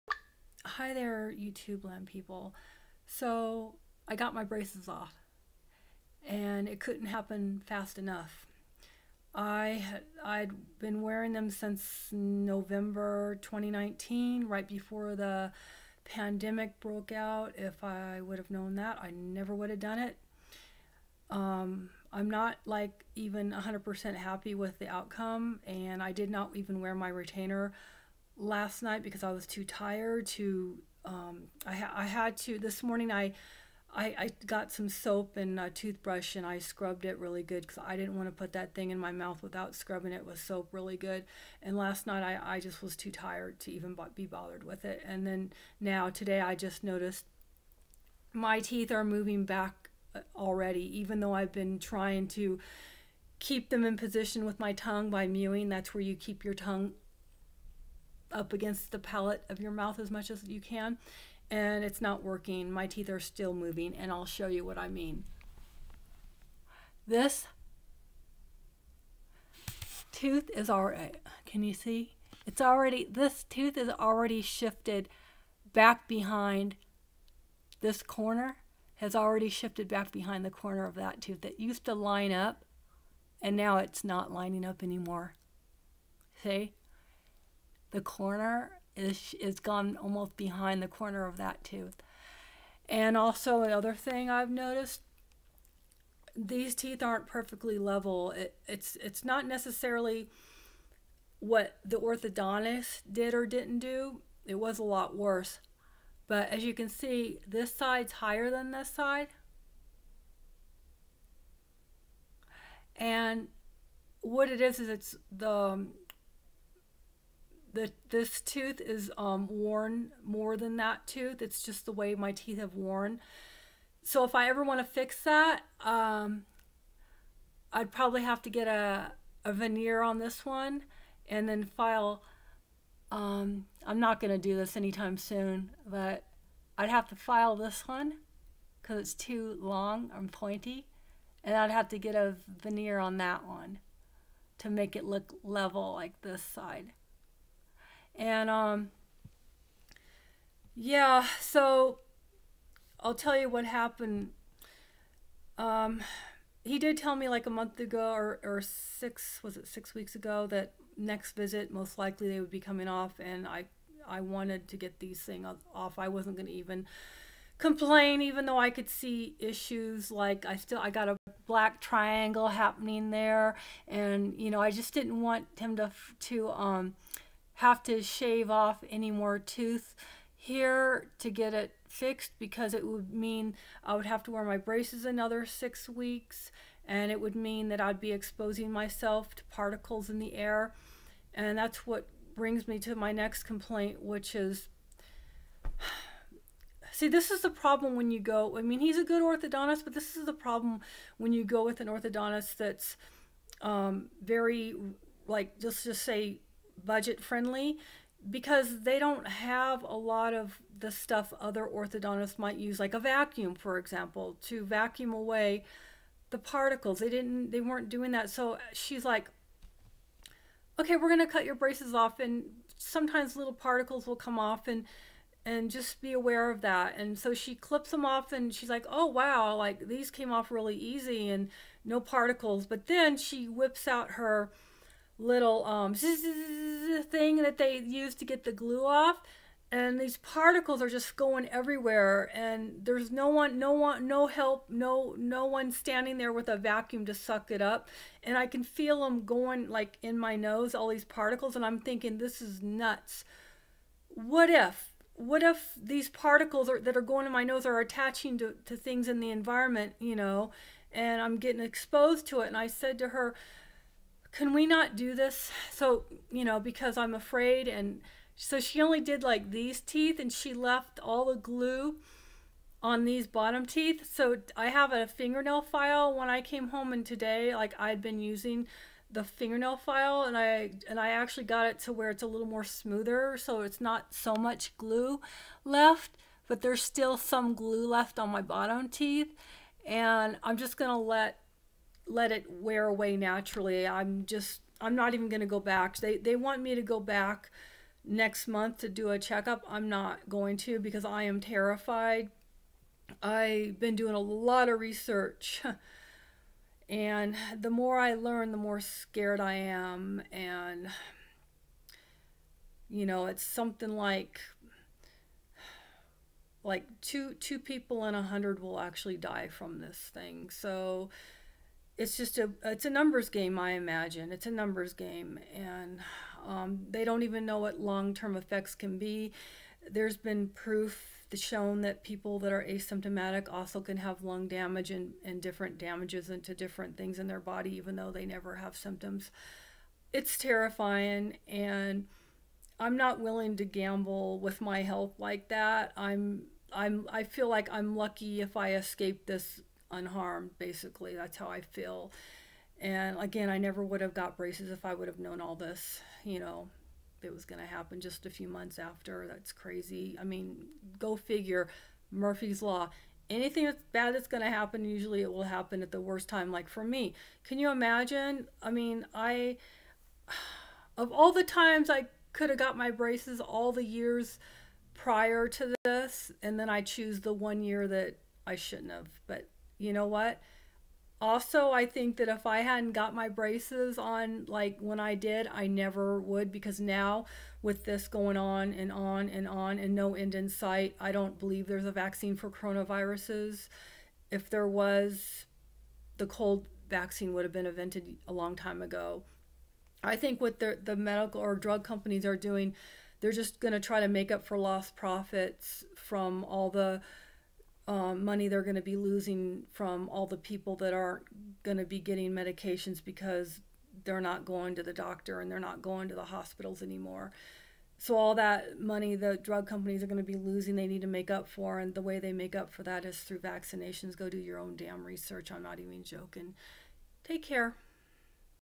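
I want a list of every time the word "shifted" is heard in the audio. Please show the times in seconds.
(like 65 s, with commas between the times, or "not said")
74 s, 79 s.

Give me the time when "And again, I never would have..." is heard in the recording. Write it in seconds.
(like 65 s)
352 s.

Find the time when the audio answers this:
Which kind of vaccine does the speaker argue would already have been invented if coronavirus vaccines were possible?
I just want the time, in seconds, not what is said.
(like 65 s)
396 s.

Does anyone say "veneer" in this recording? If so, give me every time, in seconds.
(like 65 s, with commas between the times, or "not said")
129 s, 142 s.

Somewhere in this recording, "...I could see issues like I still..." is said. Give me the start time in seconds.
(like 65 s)
168 s.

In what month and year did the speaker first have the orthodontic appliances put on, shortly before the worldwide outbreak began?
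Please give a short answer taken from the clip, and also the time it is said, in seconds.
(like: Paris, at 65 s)
November 2019, at 12 s.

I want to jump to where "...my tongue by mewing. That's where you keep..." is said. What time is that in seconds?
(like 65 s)
54 s.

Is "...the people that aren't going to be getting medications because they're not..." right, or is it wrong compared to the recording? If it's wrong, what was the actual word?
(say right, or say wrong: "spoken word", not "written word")
right.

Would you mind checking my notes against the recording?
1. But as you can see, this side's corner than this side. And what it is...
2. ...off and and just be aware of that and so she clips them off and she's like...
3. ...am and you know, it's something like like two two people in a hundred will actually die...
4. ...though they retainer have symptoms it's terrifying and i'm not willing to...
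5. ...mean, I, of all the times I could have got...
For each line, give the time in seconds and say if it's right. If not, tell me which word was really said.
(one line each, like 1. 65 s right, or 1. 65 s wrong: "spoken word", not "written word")
1. 106 s wrong: "higher", not "corner"
2. 224 s right
3. 309 s right
4. 337 s wrong: "never", not "retainer"
5. 368 s right.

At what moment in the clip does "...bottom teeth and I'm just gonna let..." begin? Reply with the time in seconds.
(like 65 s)
288 s.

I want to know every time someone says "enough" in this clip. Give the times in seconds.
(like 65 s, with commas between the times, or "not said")
7 s.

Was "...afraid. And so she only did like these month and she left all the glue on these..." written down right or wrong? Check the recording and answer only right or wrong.
wrong.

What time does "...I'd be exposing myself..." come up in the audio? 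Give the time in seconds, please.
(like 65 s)
187 s.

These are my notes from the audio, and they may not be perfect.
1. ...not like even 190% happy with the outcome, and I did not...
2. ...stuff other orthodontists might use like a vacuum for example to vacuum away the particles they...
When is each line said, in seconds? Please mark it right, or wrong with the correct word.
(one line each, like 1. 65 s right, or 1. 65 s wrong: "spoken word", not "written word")
1. 22 s wrong: "100", not "190"
2. 210 s right.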